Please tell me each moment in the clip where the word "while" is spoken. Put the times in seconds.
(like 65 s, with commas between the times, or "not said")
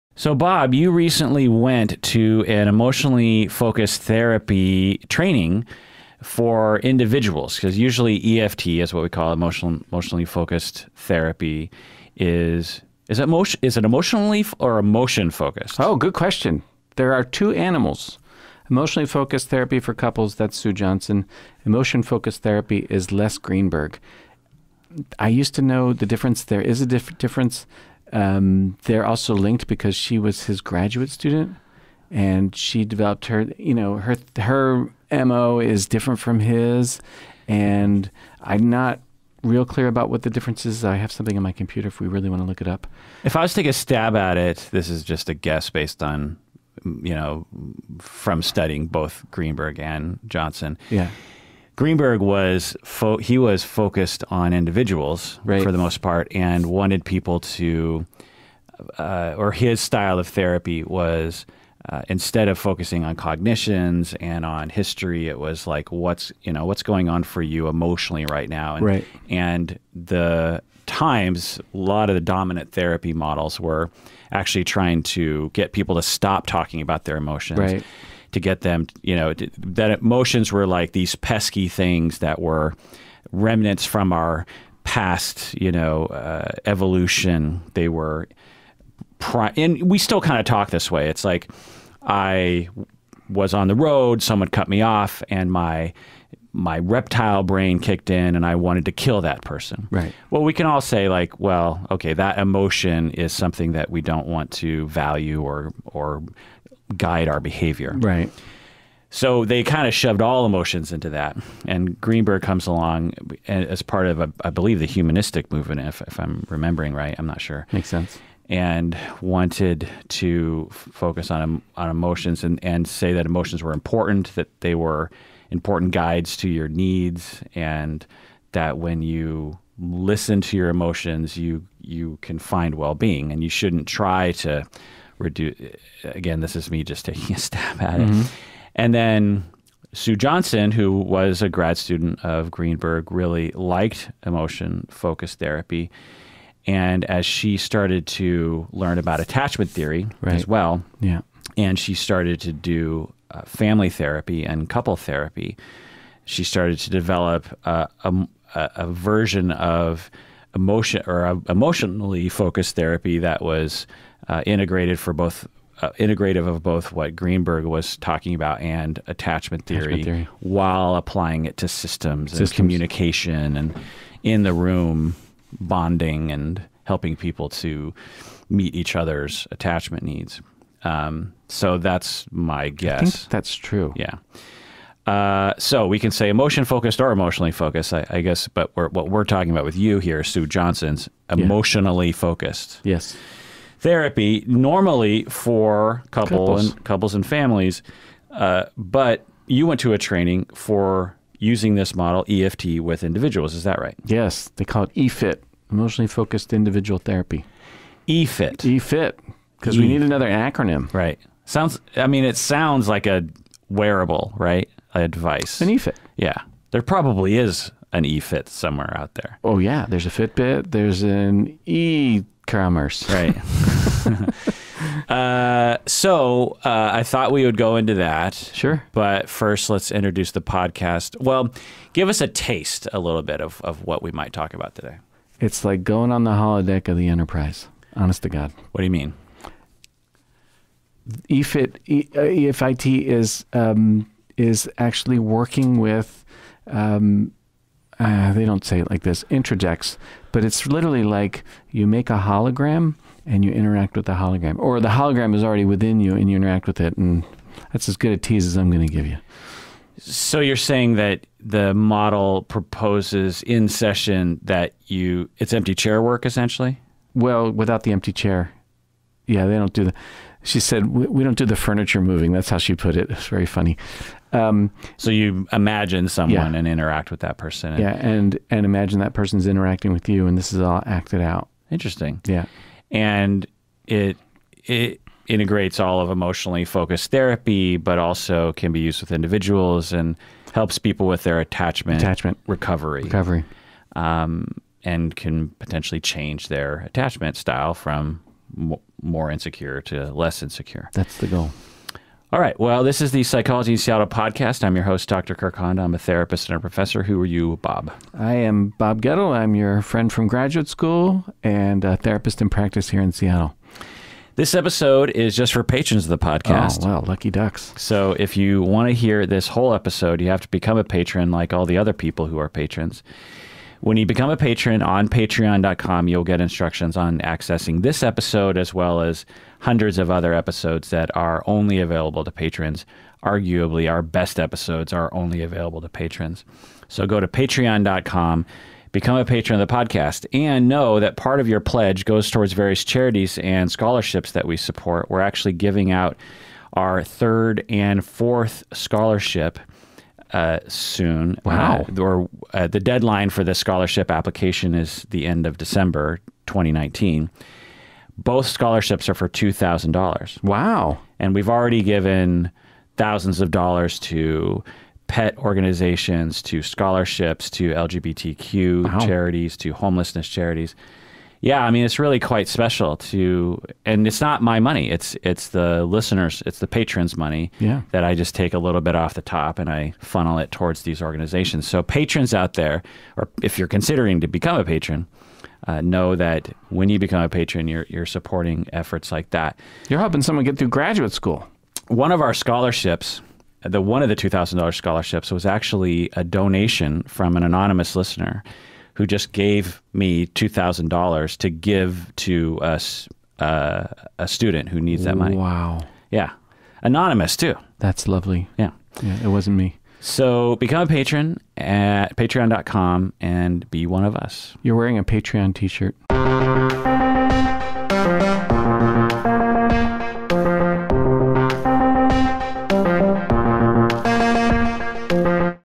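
170 s.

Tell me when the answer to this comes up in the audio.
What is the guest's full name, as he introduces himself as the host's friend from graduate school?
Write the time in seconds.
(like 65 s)
308 s.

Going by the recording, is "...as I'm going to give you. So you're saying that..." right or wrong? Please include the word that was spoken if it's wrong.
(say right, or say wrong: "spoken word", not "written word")
right.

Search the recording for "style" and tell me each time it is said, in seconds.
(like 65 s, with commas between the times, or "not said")
59 s, 297 s.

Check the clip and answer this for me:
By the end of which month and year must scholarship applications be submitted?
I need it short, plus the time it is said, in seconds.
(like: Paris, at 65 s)
December 2019, at 355 s.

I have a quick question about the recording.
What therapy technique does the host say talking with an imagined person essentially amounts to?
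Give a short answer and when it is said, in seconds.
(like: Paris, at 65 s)
empty chair work, at 265 s.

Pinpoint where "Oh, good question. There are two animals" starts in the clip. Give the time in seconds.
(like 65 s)
15 s.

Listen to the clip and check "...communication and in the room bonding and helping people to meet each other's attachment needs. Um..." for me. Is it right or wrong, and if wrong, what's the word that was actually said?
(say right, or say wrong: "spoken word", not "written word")
right.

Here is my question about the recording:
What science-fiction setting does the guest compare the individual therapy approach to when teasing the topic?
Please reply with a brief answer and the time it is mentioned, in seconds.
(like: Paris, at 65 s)
holodeck of the Enterprise, at 236 s.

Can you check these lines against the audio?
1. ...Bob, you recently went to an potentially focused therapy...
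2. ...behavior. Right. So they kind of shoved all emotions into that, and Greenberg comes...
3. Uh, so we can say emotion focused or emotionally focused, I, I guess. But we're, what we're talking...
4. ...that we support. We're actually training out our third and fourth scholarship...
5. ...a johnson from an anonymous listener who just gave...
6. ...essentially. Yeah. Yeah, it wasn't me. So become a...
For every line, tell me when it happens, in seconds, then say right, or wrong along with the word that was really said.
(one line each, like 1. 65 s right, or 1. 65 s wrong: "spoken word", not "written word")
1. 0 s wrong: "emotionally", not "potentially"
2. 107 s right
3. 185 s right
4. 344 s wrong: "giving", not "training"
5. 396 s wrong: "donation", not "johnson"
6. 408 s wrong: "lovely", not "essentially".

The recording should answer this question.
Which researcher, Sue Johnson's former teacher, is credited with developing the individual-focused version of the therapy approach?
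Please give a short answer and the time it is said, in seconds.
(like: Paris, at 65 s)
Les Greenberg, at 23 s.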